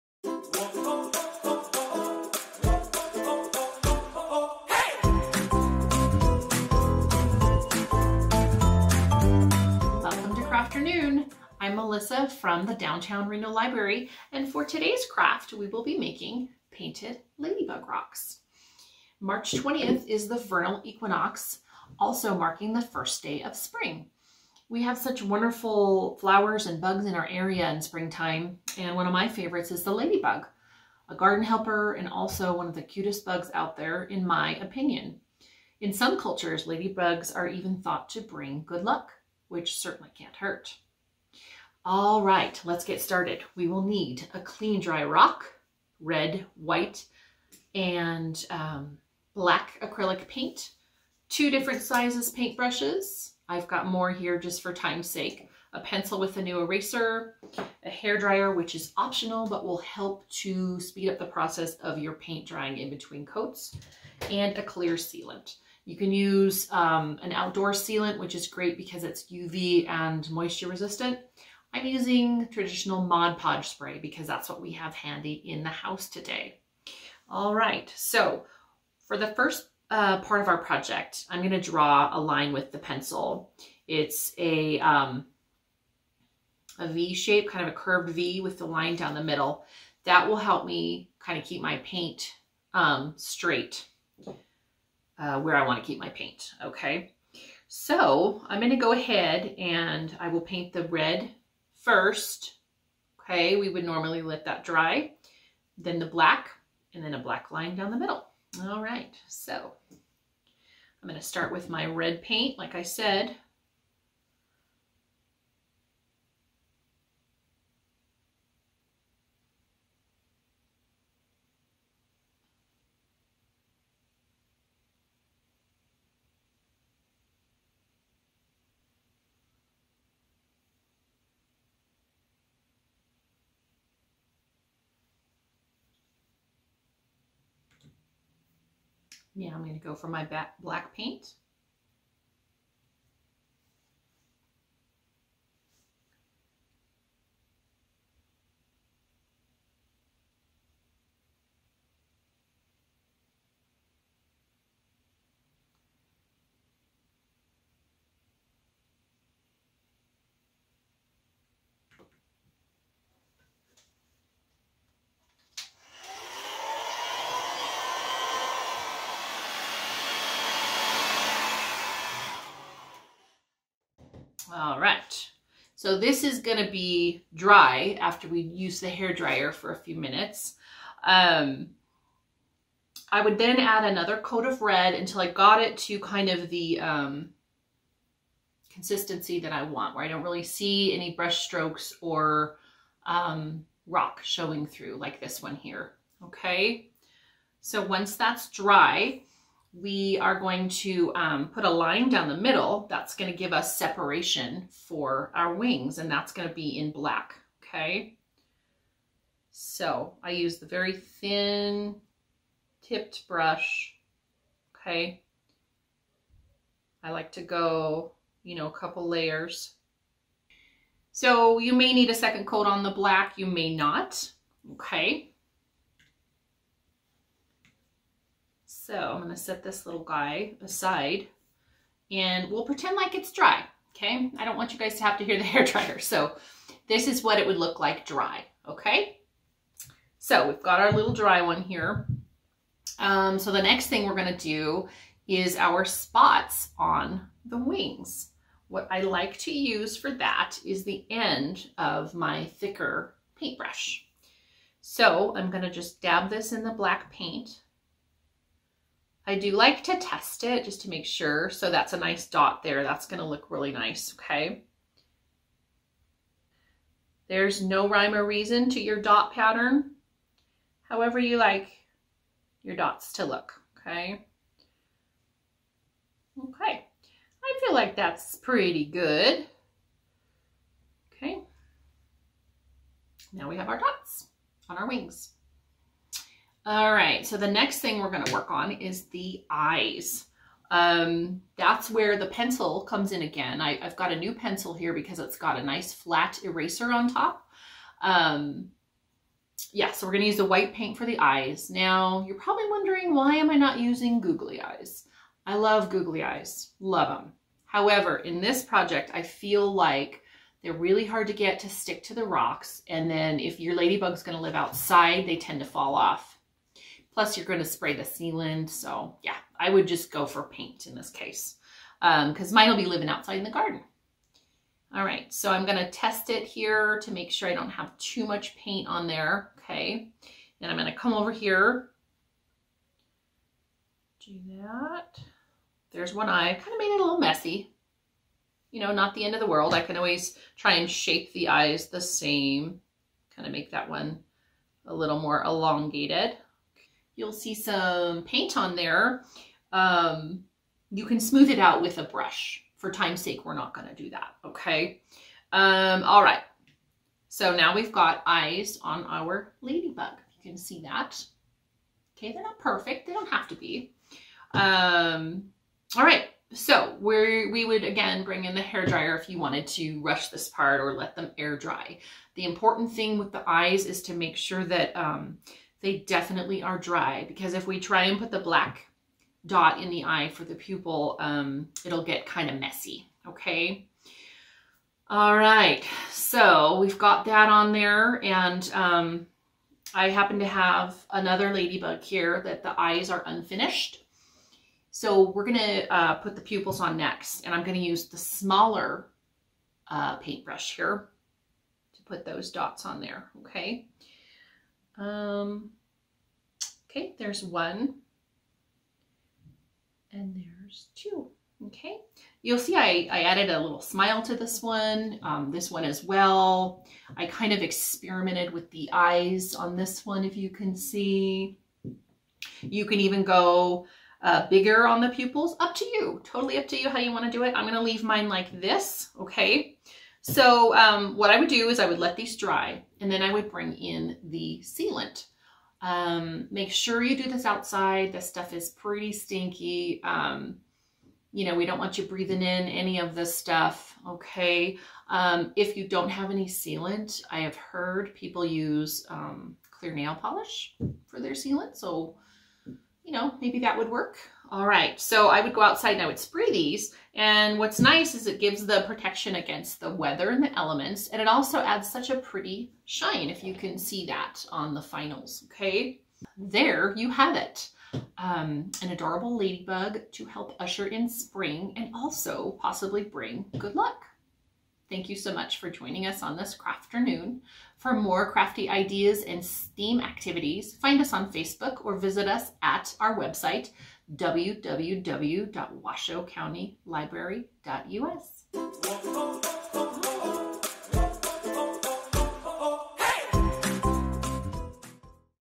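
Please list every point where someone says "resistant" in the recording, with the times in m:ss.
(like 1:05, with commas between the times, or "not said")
1:10.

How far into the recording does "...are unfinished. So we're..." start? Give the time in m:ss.
6:33.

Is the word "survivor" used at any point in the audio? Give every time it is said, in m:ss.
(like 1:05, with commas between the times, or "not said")
not said.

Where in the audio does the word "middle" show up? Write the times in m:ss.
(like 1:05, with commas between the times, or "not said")
1:29, 1:47, 3:22.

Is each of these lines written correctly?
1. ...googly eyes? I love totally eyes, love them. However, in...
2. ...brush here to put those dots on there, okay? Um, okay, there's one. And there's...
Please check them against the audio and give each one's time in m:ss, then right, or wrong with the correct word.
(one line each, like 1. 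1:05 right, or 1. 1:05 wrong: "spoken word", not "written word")
1. 5:04 wrong: "googly", not "totally"
2. 6:40 wrong: "paintbrush", not "brush".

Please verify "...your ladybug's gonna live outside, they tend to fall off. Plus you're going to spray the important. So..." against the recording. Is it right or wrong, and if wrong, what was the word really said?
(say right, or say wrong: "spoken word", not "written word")
wrong: "sealant", not "important".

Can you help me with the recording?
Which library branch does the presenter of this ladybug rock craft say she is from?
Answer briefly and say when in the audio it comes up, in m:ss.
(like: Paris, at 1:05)
Downtown Reno Library, at 0:12.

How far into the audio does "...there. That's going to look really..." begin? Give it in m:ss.
4:22.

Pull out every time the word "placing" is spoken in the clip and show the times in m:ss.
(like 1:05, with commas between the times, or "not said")
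not said.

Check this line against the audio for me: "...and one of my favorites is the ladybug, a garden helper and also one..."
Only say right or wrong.
right.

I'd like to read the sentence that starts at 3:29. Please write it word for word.
So I use the very thin tipped brush, okay?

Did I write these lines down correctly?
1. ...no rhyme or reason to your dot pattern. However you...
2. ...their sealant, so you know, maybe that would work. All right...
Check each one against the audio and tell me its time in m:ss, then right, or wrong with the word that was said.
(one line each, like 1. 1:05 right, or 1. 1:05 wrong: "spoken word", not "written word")
1. 4:27 right
2. 7:31 right.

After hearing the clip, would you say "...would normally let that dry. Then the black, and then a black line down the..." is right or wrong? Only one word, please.
right.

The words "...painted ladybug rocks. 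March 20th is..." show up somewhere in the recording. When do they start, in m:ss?
0:16.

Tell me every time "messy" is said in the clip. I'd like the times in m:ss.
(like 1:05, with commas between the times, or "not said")
5:37, 6:22.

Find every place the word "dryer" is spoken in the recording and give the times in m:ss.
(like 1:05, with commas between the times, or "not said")
0:58, 2:59, 3:55, 6:08.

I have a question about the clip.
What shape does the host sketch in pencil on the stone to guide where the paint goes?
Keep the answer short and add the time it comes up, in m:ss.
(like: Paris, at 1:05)
V shape, at 1:26.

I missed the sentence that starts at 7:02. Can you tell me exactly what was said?
You can even go uh, bigger on the pupils, up to you, totally up to you how you wanna do it.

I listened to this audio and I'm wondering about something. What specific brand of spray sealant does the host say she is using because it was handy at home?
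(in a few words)
Mod Podge.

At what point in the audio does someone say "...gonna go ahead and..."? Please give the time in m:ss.
1:38.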